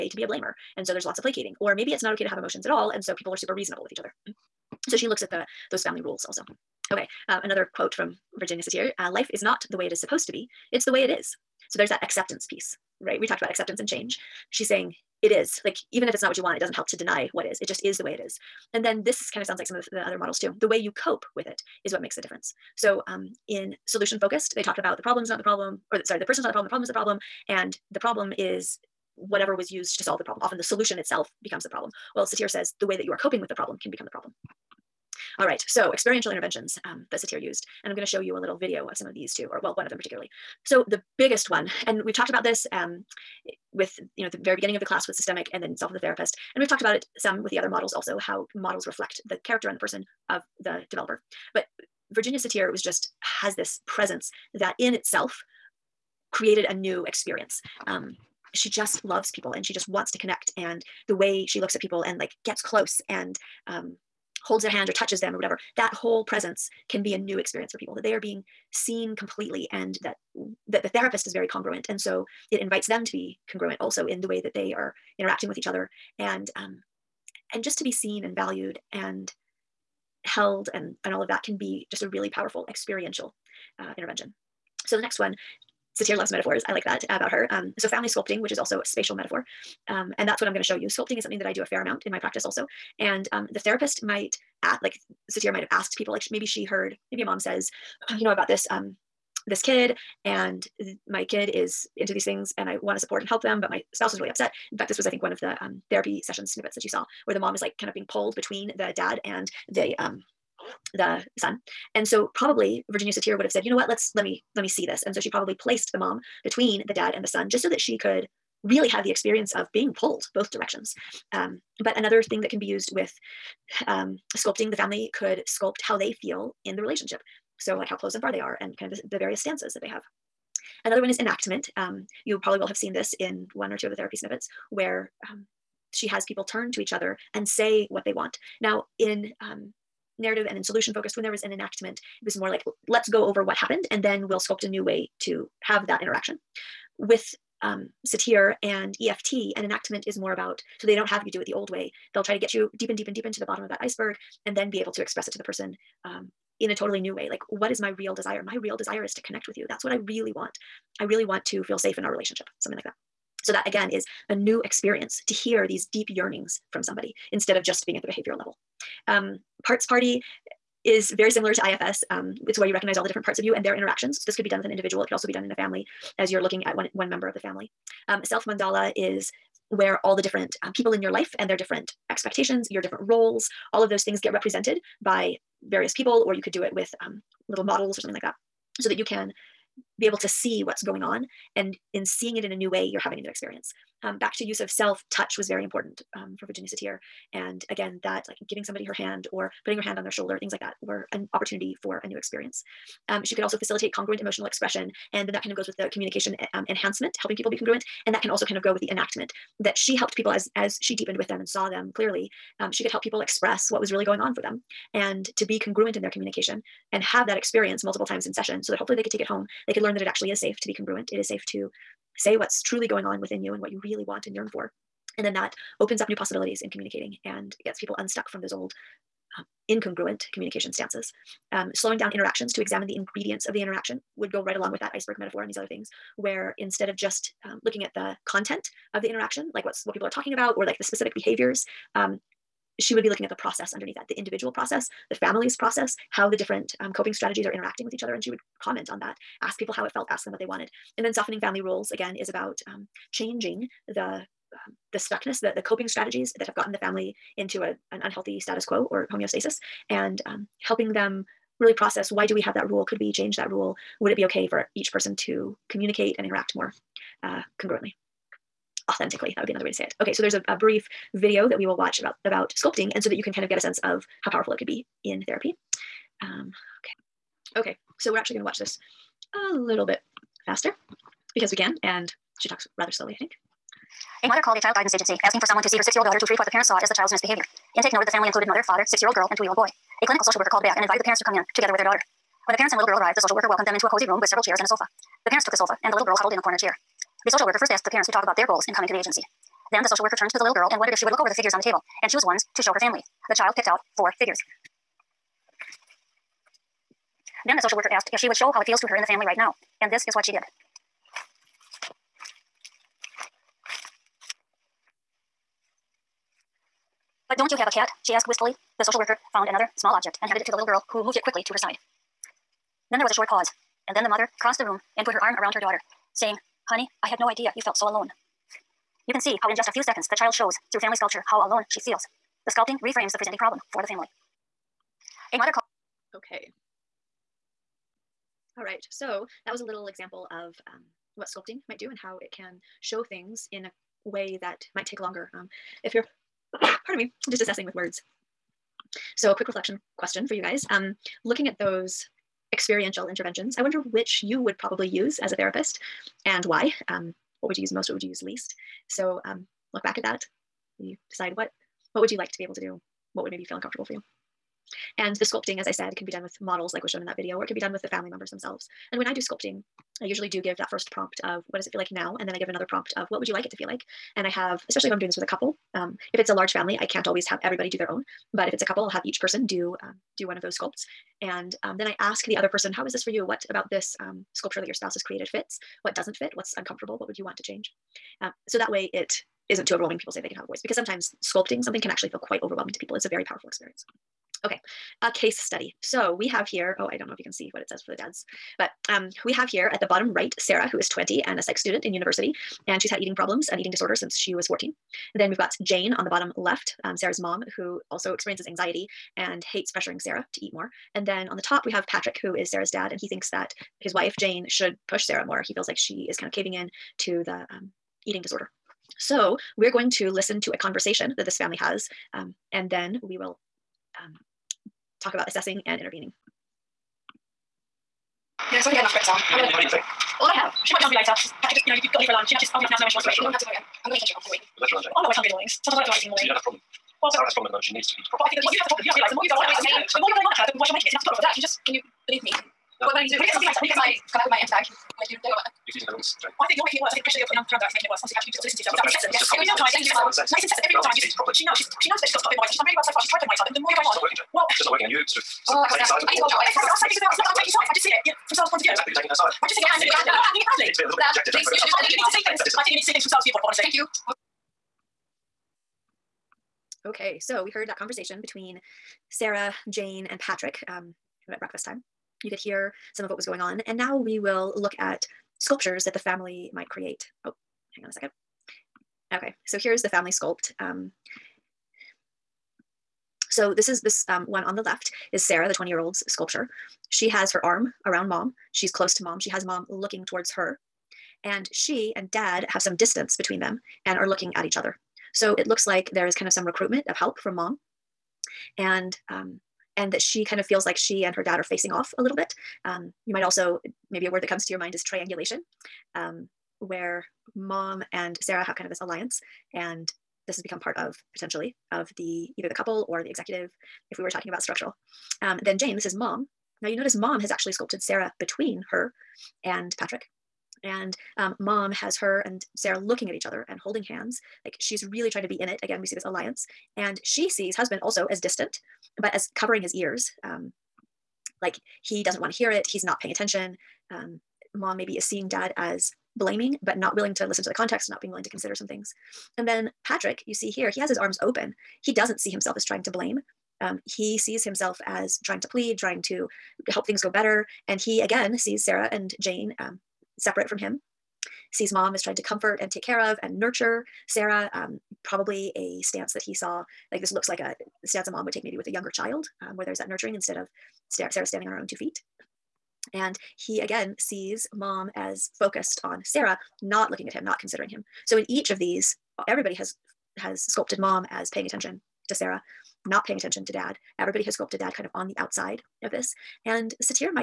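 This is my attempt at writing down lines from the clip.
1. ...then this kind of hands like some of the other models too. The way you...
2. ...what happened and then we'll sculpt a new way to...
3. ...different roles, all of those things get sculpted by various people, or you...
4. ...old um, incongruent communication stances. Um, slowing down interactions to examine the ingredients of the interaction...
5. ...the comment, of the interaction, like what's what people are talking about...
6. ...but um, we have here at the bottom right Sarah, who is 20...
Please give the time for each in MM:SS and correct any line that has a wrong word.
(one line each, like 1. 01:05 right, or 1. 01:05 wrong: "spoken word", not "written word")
1. 00:18 wrong: "sounds", not "hands"
2. 02:23 right
3. 03:02 wrong: "represented", not "sculpted"
4. 03:48 right
5. 03:57 wrong: "content", not "comment"
6. 06:38 right.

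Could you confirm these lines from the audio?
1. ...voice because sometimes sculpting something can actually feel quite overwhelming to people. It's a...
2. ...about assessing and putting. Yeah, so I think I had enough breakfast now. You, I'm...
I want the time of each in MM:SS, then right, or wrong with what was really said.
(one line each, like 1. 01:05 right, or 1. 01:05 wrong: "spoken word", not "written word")
1. 06:30 right
2. 07:05 wrong: "intervening", not "putting".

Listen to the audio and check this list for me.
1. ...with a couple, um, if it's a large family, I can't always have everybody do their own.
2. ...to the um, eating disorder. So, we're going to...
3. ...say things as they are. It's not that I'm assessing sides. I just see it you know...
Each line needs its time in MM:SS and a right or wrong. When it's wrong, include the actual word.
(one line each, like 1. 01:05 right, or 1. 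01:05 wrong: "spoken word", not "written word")
1. 06:15 right
2. 06:56 right
3. 07:36 wrong: "taking", not "assessing".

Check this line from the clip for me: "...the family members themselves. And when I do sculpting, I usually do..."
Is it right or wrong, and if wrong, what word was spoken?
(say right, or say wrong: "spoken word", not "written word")
right.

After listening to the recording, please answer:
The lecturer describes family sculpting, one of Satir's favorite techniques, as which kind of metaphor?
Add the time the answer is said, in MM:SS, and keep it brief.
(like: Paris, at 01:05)
spatial metaphor, at 01:28.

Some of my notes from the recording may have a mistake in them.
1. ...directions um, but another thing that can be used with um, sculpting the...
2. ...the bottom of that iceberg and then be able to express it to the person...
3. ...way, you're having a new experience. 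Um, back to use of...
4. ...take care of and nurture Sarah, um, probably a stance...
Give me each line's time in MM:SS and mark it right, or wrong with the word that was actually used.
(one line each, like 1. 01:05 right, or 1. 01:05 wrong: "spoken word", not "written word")
1. 02:00 right
2. 02:33 right
3. 03:12 right
4. 09:12 right.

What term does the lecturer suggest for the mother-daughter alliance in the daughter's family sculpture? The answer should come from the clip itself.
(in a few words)
triangulation.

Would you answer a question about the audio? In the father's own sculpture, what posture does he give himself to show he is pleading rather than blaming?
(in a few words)
arms open.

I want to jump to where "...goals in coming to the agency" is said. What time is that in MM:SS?
04:58.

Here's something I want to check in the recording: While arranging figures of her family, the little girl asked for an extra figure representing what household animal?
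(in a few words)
cat.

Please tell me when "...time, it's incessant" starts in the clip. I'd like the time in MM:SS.
07:29.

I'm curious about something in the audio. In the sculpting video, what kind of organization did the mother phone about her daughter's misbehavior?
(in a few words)
child guidance agency.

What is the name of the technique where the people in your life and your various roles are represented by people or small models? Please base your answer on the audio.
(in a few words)
self mandala.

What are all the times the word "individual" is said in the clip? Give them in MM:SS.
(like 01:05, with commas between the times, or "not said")
02:54, 04:04.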